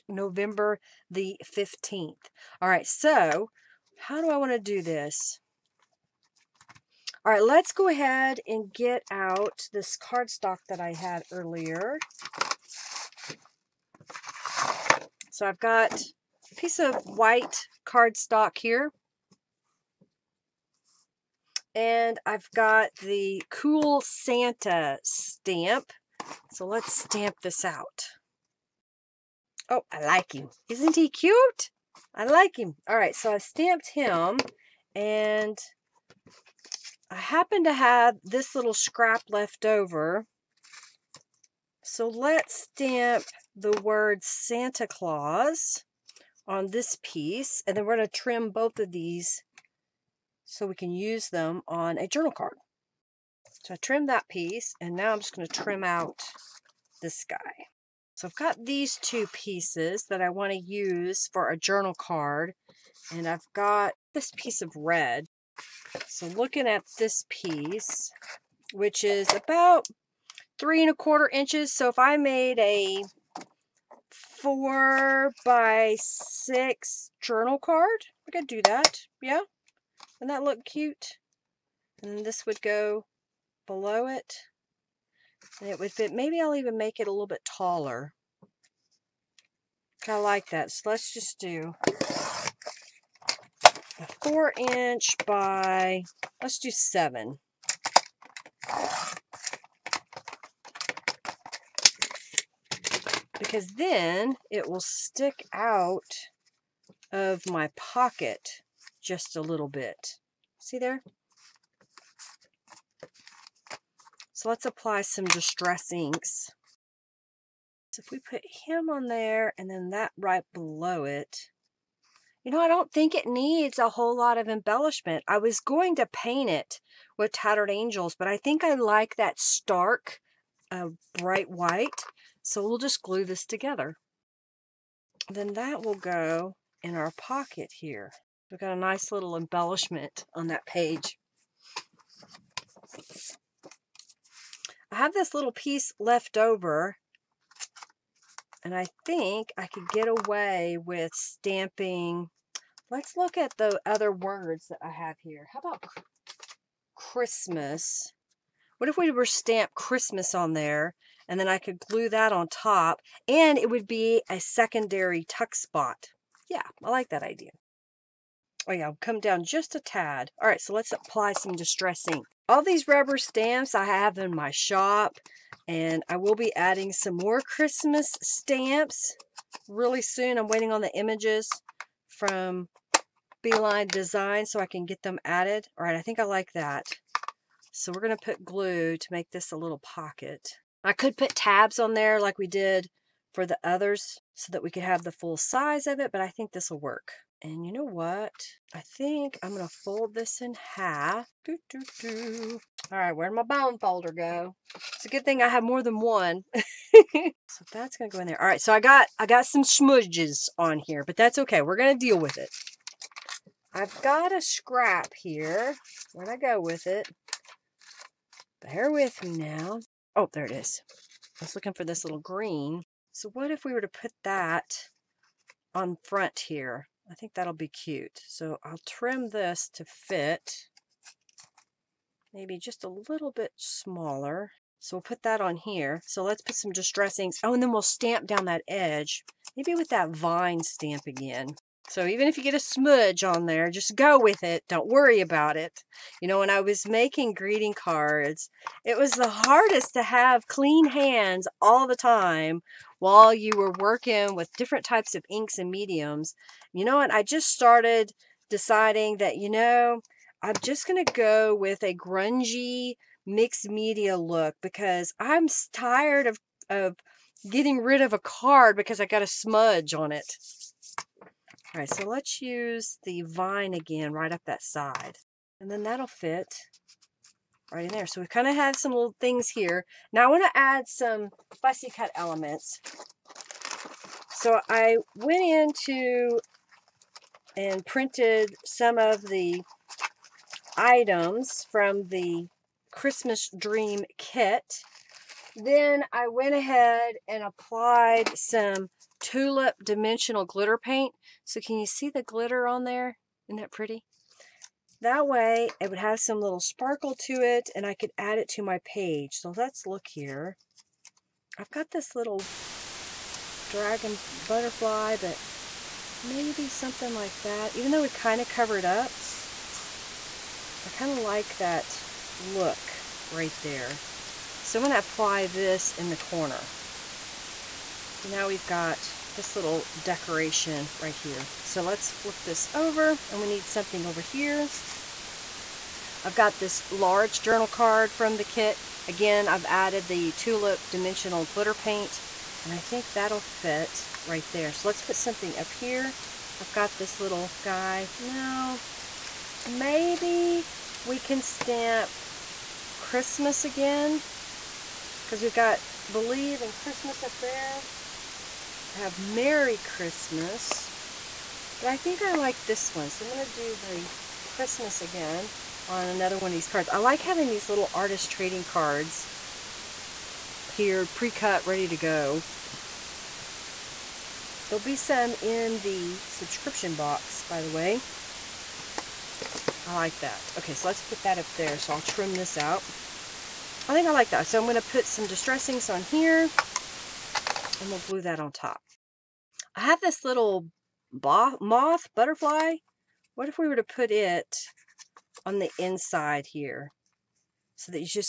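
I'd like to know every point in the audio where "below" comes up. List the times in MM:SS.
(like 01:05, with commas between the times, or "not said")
01:23, 02:00.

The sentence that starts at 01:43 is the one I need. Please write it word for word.
because then it will stick out of my pocket just a little bit.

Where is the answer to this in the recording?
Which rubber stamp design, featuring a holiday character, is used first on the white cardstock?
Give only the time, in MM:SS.
00:23.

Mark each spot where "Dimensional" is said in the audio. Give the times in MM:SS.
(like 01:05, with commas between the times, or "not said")
04:59, 05:40.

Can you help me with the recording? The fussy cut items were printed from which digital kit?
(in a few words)
Christmas Dream.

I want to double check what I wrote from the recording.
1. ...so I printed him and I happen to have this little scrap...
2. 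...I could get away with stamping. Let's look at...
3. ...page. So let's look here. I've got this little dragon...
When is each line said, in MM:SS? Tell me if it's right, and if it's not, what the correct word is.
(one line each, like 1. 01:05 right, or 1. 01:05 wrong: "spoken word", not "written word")
1. 00:33 wrong: "stamped", not "printed"
2. 02:29 right
3. 05:08 right.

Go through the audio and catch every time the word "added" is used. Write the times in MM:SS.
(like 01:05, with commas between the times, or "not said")
03:05, 05:39.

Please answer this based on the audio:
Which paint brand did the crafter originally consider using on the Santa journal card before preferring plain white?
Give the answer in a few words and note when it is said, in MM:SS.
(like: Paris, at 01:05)
Tattered Angels, at 02:07.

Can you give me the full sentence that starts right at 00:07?
All right, let's go ahead and get out this cardstock that I had earlier.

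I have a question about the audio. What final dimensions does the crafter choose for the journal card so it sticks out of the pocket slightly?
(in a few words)
4 by 7 inches.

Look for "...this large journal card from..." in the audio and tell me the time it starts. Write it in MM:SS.
05:36.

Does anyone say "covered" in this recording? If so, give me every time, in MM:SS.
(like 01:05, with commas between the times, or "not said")
05:18.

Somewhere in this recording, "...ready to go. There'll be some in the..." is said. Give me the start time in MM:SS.
06:11.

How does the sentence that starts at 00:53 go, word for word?
So I trimmed that piece and now I'm just going to trim out this guy.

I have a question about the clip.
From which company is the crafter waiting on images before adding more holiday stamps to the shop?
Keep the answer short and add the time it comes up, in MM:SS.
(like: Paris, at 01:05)
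B Line Design, at 03:03.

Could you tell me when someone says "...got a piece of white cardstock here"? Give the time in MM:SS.
00:15.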